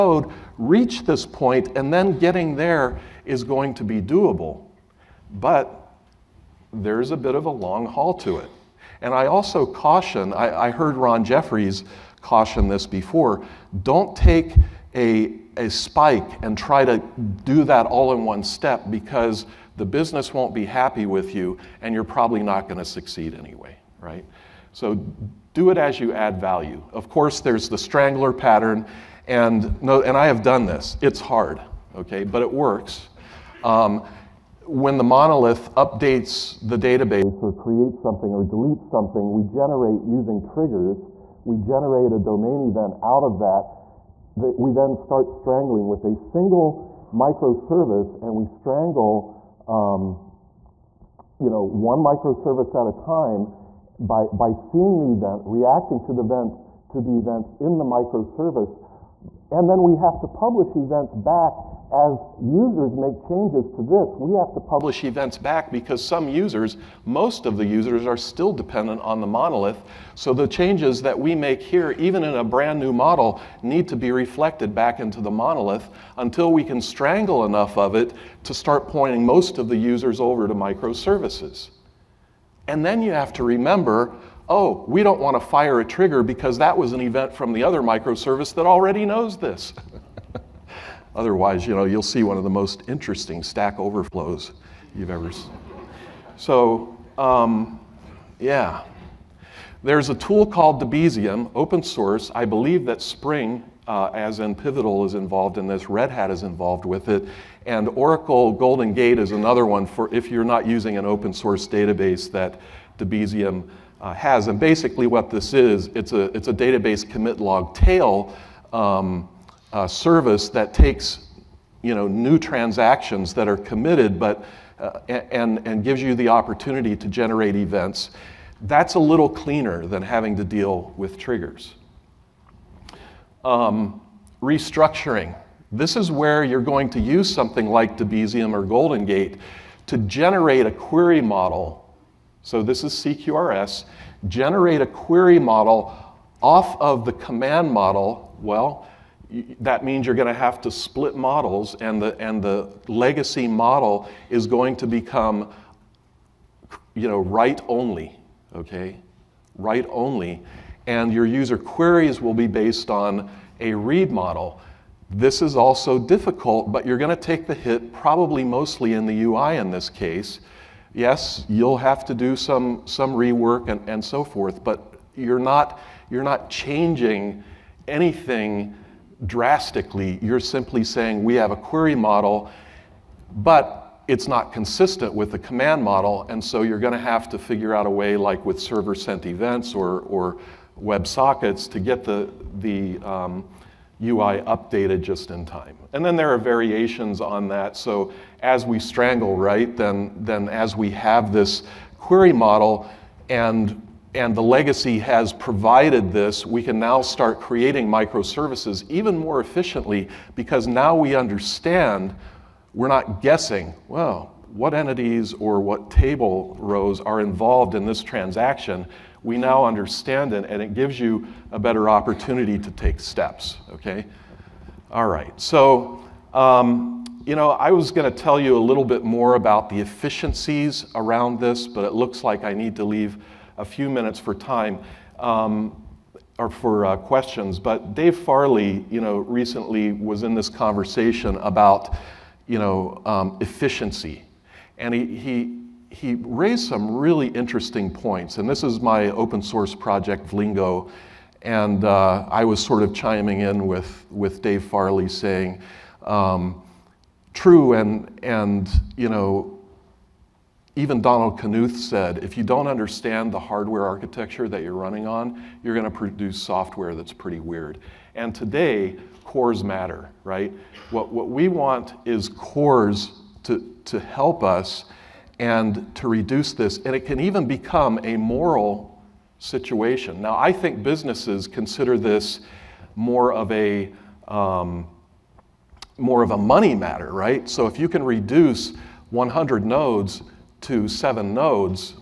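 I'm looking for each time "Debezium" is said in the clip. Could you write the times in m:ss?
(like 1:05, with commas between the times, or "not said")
1:40, 1:52, 2:17.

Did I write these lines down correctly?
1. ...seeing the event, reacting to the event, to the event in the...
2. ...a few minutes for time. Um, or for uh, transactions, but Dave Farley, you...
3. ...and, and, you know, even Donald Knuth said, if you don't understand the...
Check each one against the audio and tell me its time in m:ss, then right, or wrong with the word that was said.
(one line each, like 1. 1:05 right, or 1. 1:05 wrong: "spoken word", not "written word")
1. 0:54 right
2. 3:53 wrong: "questions", not "transactions"
3. 4:17 right.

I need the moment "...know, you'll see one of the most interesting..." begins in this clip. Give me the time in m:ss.
1:31.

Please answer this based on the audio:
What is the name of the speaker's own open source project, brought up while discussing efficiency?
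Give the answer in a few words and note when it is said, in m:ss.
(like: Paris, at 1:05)
Vlingo, at 4:10.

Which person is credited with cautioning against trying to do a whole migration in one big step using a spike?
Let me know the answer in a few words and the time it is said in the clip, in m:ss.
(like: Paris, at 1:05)
Ron Jeffries, at 0:10.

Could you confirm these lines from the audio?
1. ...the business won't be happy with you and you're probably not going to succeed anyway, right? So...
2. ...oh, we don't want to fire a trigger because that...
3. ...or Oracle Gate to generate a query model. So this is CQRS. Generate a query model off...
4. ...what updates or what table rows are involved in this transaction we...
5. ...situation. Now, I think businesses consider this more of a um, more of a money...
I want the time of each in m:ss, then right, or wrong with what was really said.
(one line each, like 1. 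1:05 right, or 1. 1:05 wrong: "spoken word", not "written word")
1. 0:19 right
2. 1:24 right
3. 2:18 wrong: "Golden", not "Oracle"
4. 3:34 wrong: "entities", not "updates"
5. 4:39 right.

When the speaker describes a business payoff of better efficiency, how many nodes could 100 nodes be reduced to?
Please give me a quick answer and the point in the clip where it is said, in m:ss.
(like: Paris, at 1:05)
7, at 4:50.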